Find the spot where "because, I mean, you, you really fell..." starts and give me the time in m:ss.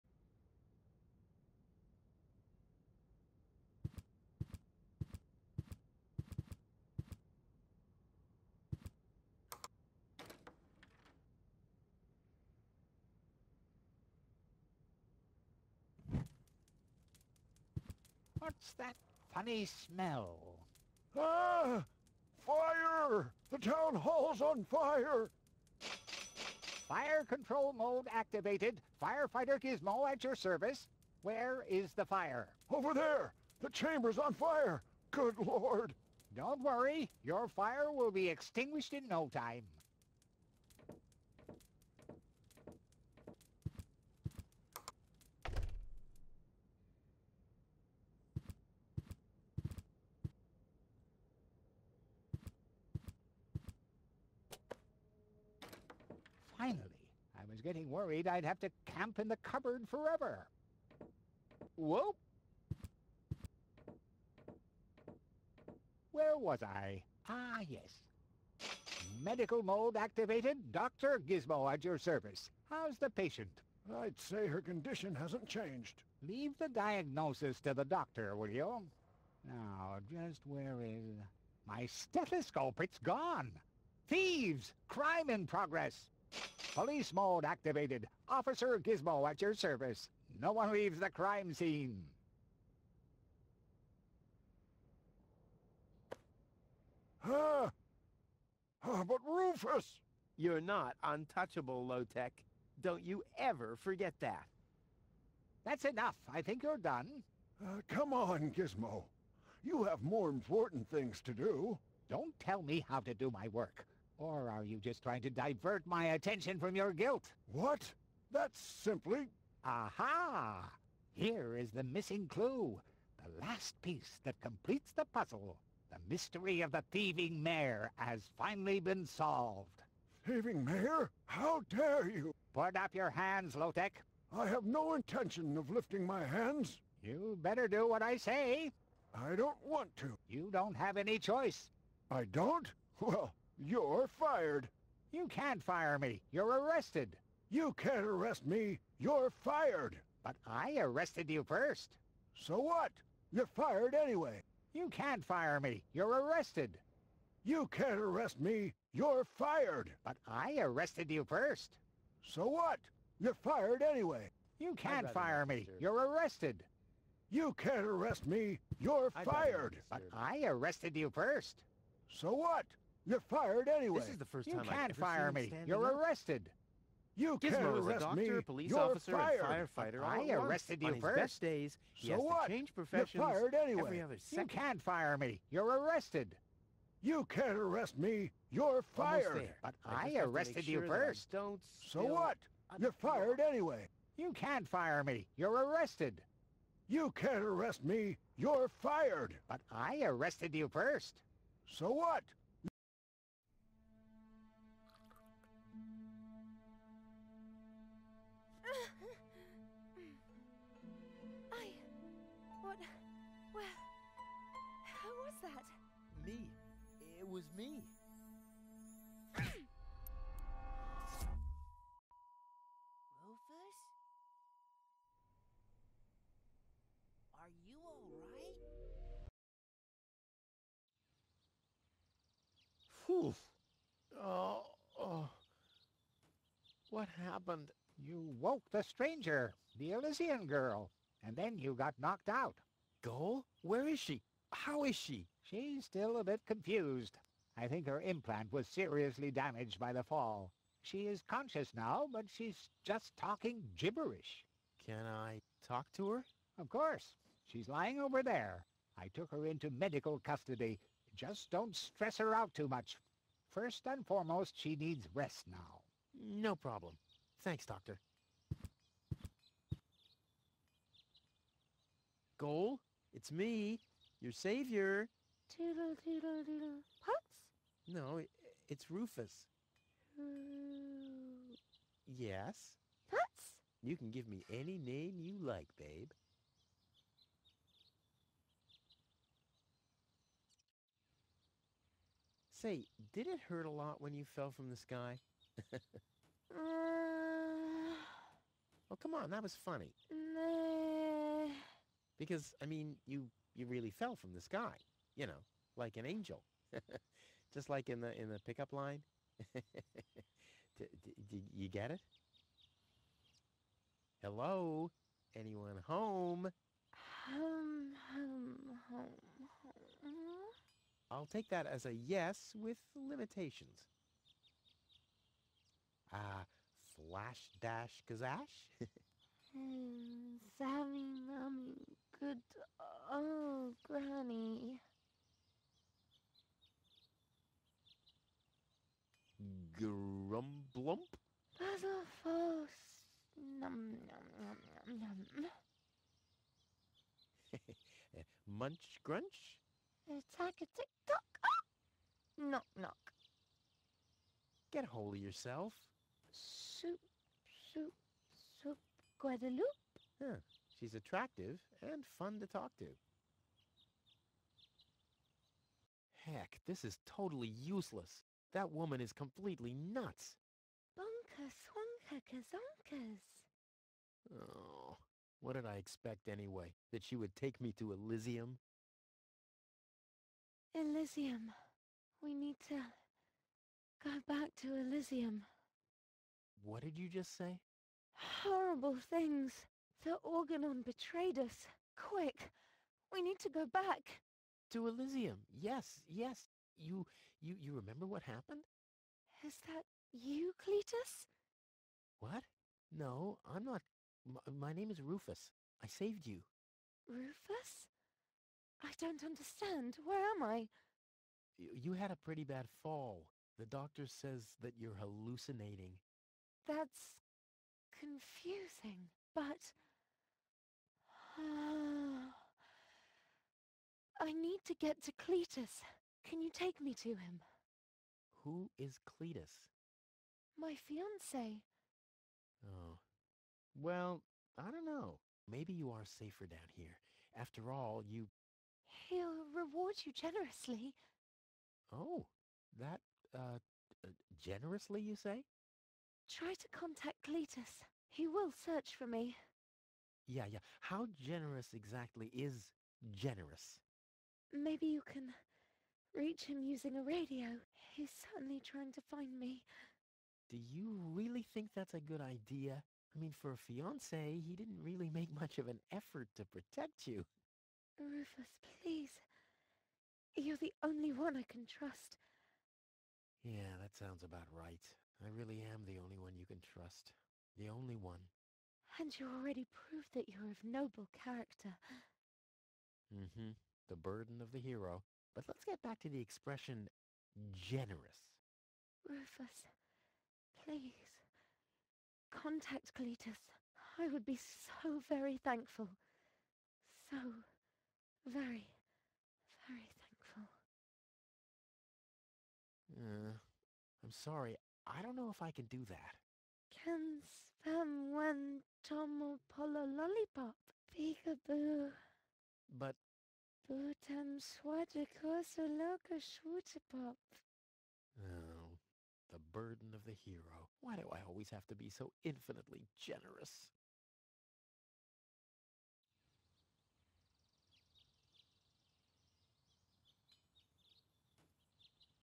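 5:02.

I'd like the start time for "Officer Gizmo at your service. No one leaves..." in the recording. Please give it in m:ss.
1:28.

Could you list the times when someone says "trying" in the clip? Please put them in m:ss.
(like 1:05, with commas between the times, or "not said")
1:55, 7:38.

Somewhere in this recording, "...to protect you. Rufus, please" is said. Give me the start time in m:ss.
7:46.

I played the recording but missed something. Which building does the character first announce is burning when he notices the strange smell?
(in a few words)
The town hall.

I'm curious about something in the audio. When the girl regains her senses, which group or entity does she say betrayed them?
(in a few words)
The Organon.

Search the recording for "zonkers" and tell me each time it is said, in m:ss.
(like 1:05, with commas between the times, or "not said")
6:12.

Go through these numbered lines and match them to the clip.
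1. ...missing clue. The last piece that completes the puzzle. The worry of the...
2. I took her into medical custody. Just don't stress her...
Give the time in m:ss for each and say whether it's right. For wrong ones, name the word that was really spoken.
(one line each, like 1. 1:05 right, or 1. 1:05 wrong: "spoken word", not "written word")
1. 2:01 wrong: "mystery", not "worry"
2. 4:18 right.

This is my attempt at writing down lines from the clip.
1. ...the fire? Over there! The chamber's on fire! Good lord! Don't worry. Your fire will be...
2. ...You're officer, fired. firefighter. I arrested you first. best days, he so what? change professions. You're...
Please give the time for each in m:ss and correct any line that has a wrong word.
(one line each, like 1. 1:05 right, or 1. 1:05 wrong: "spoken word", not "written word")
1. 0:31 right
2. 2:58 right.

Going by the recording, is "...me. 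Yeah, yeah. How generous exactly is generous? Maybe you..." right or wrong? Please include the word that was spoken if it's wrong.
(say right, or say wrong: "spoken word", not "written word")
right.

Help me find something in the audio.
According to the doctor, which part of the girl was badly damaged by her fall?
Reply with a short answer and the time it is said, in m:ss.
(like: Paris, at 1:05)
Her implant, at 4:07.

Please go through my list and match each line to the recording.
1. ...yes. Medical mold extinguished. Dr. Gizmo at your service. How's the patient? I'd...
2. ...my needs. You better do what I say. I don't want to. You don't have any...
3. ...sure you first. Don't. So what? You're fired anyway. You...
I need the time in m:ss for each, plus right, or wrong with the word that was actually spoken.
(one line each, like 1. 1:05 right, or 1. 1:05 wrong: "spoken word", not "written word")
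1. 1:07 wrong: "activated", not "extinguished"
2. 2:16 wrong: "hands", not "needs"
3. 3:10 right.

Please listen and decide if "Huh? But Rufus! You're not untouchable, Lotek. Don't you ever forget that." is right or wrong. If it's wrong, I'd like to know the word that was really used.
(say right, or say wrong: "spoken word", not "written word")
right.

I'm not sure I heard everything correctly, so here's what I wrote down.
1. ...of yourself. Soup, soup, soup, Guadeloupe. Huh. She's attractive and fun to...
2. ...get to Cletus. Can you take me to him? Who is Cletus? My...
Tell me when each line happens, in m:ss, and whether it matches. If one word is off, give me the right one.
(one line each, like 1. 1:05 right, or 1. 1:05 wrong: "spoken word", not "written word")
1. 5:55 right
2. 7:04 right.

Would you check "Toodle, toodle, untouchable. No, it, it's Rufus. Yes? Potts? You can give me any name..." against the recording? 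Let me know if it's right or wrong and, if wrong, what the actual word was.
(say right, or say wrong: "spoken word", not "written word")
wrong: "doodle", not "untouchable".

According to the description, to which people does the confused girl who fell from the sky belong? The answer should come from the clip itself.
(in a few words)
Elysian.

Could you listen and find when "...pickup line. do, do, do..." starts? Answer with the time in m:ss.
5:08.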